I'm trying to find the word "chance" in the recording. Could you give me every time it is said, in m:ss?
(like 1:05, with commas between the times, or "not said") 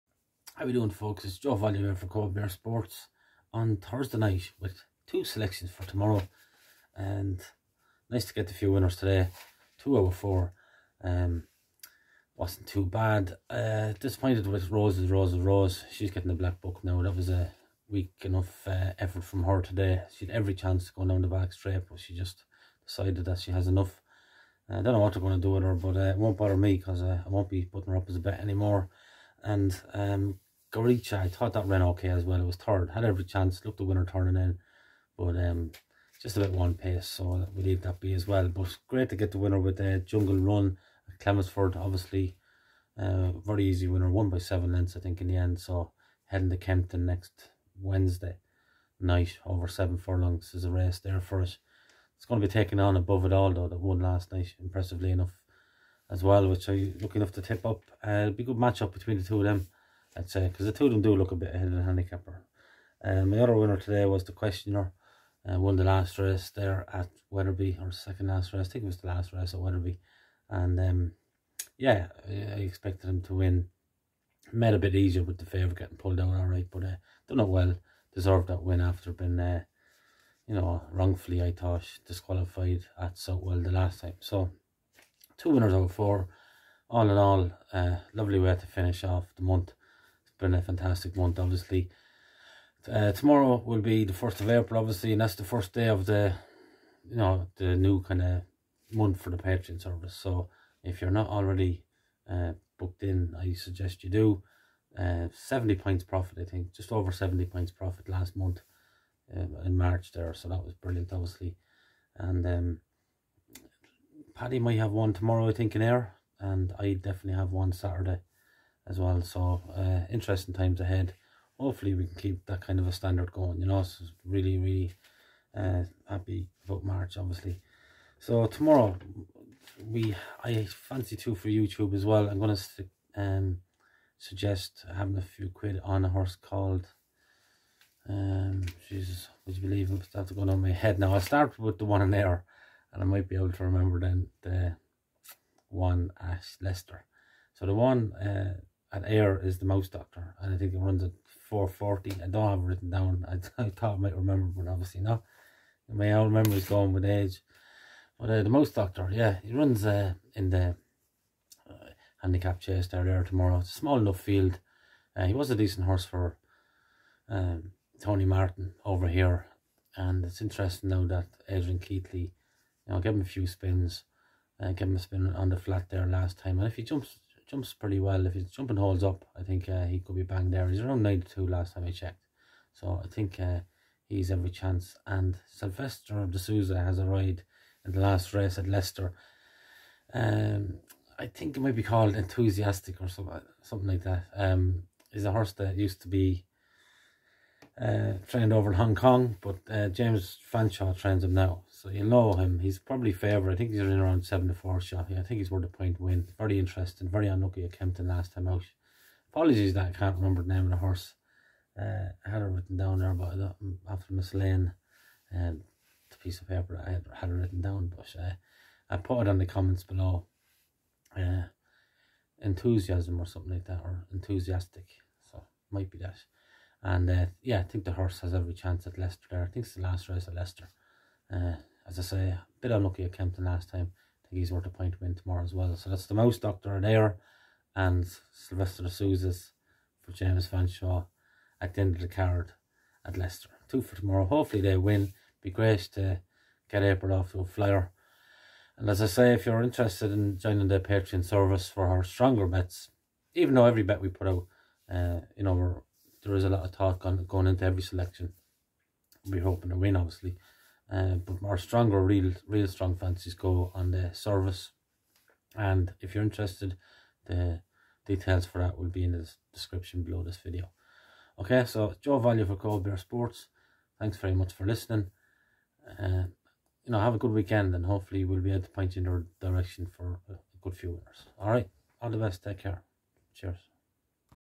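0:20, 0:33, 3:04, 3:48.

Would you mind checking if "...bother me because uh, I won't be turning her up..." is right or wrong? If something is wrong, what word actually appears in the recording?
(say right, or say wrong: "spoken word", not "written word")
wrong: "putting", not "turning".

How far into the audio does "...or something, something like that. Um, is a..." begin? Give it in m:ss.
3:13.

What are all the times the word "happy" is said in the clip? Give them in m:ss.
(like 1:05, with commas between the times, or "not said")
2:06.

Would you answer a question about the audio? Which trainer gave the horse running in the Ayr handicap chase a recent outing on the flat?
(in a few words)
Adrian Keatley.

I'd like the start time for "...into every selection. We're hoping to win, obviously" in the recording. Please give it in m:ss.
4:17.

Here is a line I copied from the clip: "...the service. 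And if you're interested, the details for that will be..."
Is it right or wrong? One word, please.
right.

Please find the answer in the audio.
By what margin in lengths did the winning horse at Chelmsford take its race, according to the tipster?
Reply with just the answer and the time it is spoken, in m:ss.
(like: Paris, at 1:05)
7 lengths, at 0:44.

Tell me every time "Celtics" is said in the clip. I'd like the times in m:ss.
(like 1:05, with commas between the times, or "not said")
not said.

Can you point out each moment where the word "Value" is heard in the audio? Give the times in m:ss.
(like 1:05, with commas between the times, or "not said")
0:01, 4:32.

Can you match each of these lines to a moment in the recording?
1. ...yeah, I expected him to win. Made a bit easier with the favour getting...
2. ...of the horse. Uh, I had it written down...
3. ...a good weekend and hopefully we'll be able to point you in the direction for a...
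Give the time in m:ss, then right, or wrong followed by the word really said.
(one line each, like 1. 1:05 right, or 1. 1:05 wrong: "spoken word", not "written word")
1. 1:11 right
2. 3:30 right
3. 4:37 right.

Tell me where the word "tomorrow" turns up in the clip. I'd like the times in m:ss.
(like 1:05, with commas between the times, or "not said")
0:05, 1:33, 1:55, 2:08, 2:43, 3:55, 4:03.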